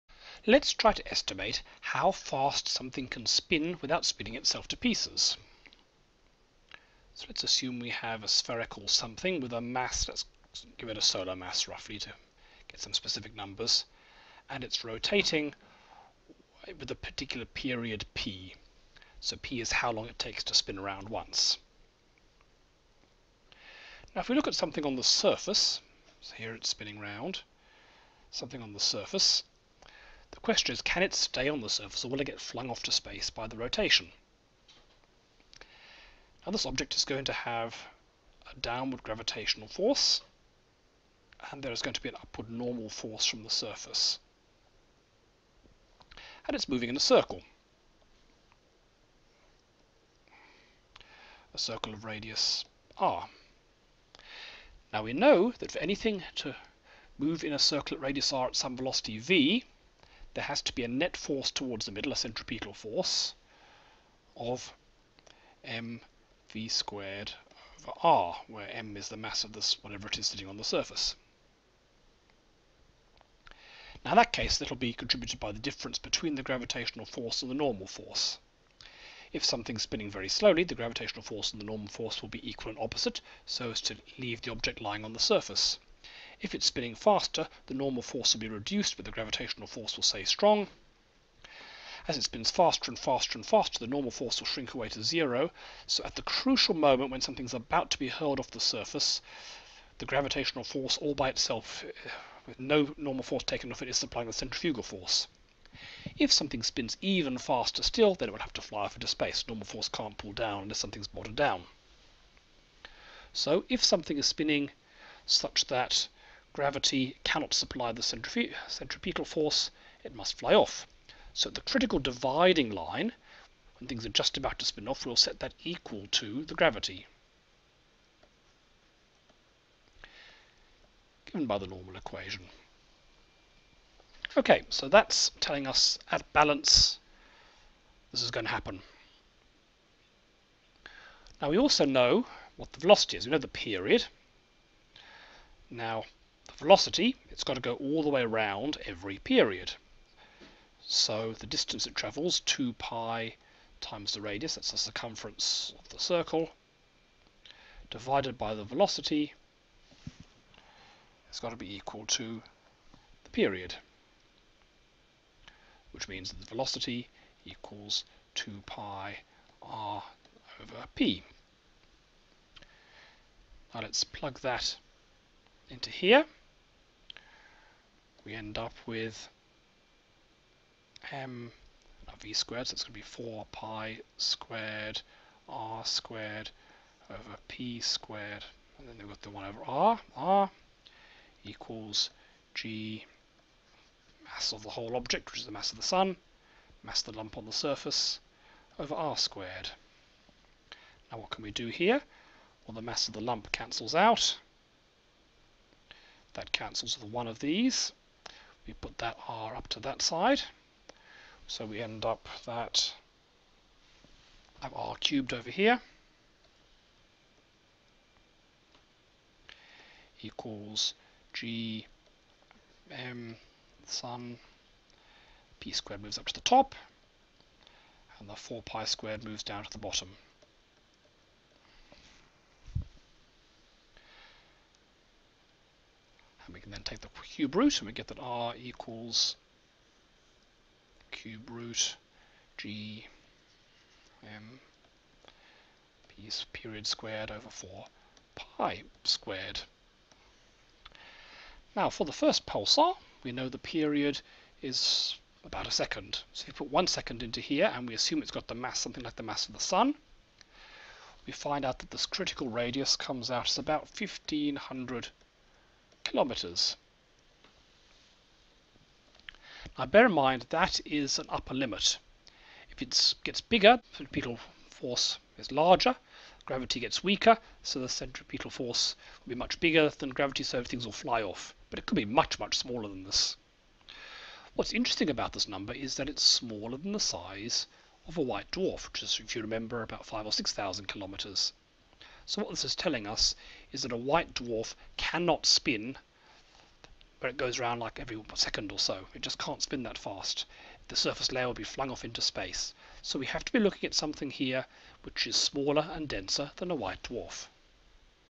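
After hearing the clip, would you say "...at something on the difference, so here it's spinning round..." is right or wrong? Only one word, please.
wrong.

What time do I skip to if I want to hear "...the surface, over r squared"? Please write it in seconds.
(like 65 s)
197 s.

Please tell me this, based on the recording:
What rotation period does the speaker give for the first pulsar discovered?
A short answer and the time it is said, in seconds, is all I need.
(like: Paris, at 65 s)
About a second, at 255 s.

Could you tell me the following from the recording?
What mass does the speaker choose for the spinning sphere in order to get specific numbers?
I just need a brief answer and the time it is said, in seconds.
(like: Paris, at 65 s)
A solar mass, at 10 s.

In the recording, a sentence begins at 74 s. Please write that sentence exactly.
Now in that case, that'll be contributed by the difference between the gravitational force and the normal force.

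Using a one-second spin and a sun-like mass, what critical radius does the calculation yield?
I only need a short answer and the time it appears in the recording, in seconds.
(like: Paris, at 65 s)
1500 kilometers, at 263 s.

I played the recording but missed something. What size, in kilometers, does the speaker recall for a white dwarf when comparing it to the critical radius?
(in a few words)
5,000 to 6,000 kilometers.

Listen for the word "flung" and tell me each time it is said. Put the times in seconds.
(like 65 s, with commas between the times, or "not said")
32 s, 301 s.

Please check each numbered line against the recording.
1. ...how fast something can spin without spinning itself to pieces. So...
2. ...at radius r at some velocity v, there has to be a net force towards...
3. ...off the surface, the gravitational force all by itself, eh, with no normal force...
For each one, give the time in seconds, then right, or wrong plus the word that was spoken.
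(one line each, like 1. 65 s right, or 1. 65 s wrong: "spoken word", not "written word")
1. 1 s right
2. 57 s right
3. 98 s right.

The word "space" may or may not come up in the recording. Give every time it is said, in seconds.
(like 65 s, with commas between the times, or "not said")
32 s, 109 s, 302 s.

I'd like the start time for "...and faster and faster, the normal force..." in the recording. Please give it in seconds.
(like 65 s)
92 s.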